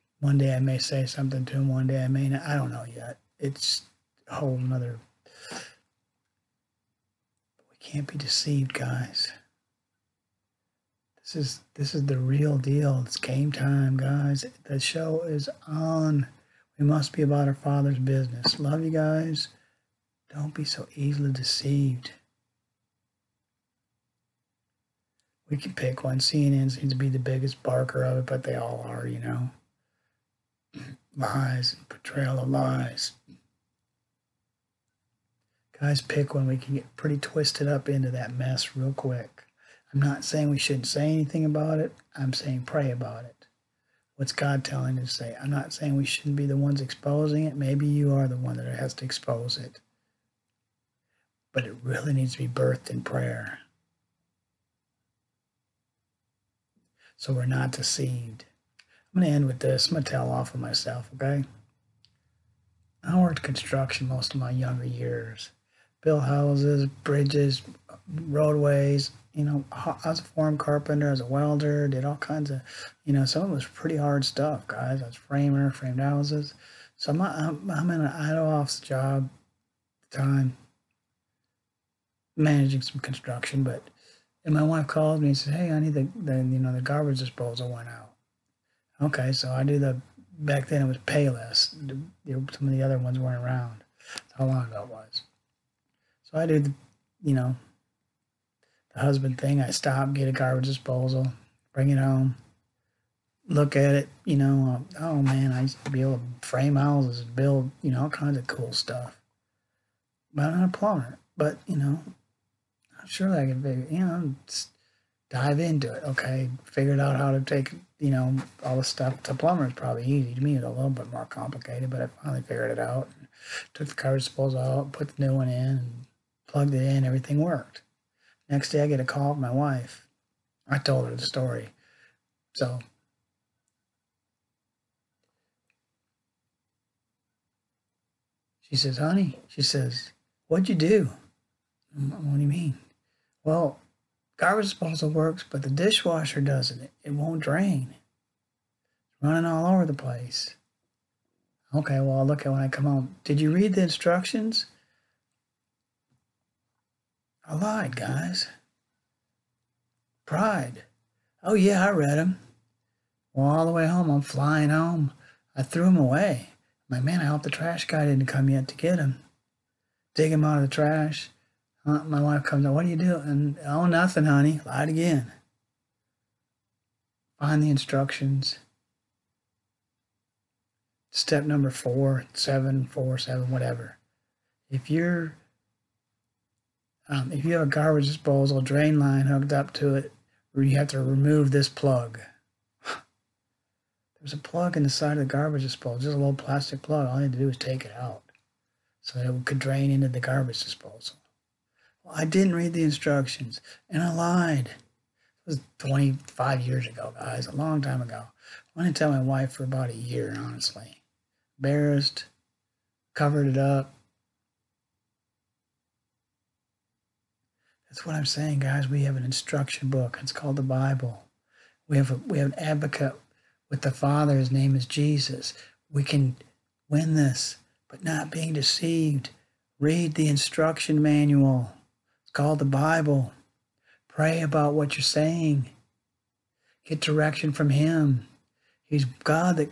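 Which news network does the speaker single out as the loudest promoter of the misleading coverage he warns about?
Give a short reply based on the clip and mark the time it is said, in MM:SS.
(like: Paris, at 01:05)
CNN, at 00:26.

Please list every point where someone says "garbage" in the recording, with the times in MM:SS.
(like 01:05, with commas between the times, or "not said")
01:26, 01:40, 02:03, 02:24, 03:07, 03:15, 03:20.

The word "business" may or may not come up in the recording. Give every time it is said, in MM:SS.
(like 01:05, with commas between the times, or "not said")
00:17.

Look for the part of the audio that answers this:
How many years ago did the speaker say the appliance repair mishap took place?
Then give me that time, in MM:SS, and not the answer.
03:25.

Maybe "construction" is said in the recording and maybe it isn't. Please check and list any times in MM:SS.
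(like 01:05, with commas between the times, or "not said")
01:03, 01:23.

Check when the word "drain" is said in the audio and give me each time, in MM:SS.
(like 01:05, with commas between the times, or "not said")
02:27, 03:08, 03:19.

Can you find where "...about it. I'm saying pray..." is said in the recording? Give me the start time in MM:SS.
00:41.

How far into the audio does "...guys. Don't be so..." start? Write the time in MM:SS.
00:18.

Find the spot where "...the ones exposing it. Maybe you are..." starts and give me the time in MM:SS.
00:46.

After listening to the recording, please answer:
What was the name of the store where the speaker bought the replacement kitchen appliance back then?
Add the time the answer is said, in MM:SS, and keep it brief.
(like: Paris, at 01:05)
Payless, at 01:30.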